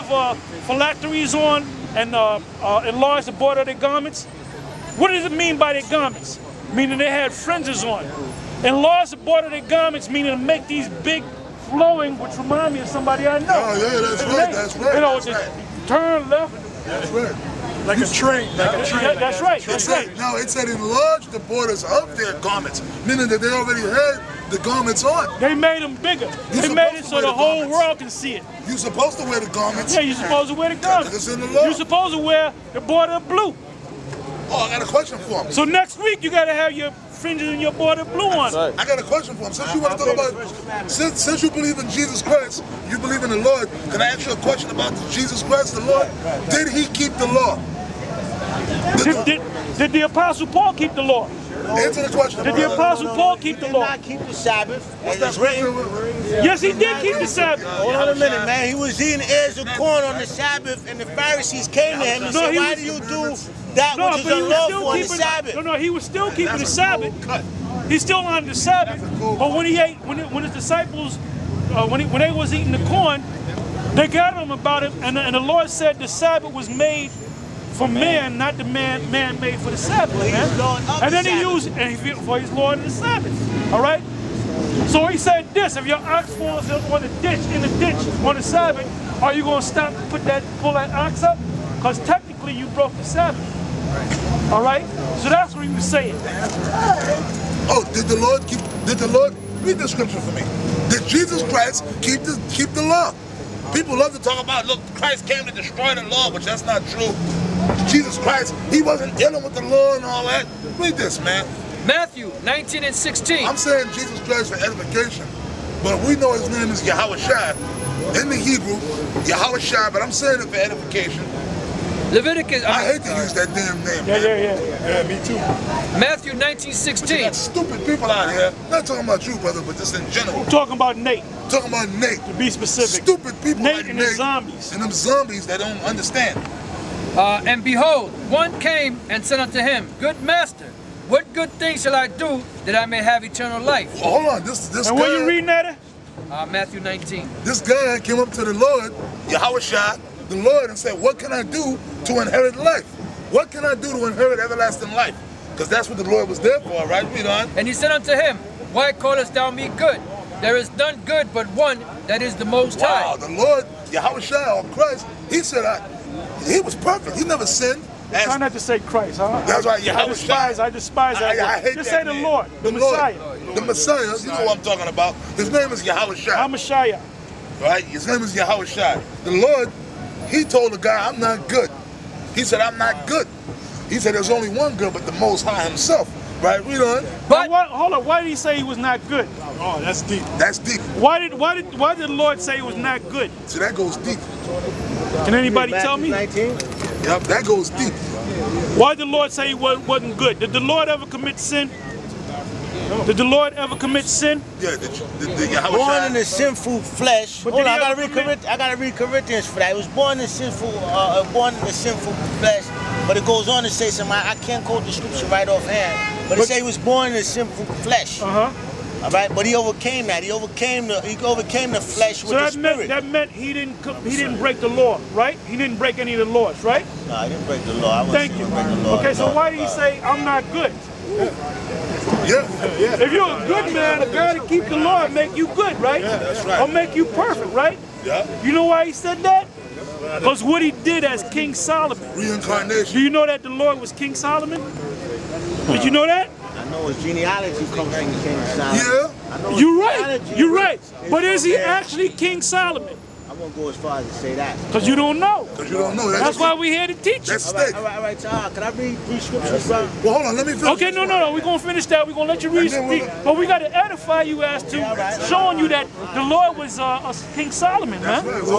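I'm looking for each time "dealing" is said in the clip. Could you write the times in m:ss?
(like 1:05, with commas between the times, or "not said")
1:49.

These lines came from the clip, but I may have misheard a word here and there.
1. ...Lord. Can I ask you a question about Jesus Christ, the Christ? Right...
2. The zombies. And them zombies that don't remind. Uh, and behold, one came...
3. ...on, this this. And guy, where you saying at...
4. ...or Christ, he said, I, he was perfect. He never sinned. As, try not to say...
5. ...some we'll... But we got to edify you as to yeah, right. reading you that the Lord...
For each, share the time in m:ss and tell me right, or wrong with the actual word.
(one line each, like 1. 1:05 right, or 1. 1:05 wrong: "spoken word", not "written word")
1. 0:43 wrong: "Lord", not "Christ"
2. 2:14 wrong: "understand", not "remind"
3. 2:24 wrong: "reading", not "saying"
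4. 2:44 right
5. 4:22 wrong: "showing", not "reading".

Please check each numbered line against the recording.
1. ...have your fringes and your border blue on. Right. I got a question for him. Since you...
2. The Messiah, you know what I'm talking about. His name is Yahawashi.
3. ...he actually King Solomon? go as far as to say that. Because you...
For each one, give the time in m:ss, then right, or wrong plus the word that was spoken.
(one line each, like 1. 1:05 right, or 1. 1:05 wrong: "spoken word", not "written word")
1. 0:36 right
2. 2:53 right
3. 4:11 right.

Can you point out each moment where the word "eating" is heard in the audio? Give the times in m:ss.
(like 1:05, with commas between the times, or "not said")
0:59, 1:12.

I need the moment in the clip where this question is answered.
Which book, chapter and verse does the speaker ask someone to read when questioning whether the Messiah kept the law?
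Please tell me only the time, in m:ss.
1:51.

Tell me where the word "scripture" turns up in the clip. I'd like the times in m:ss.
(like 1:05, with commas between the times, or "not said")
1:39, 3:34, 4:19.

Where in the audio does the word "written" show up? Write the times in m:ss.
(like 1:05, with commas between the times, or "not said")
0:55.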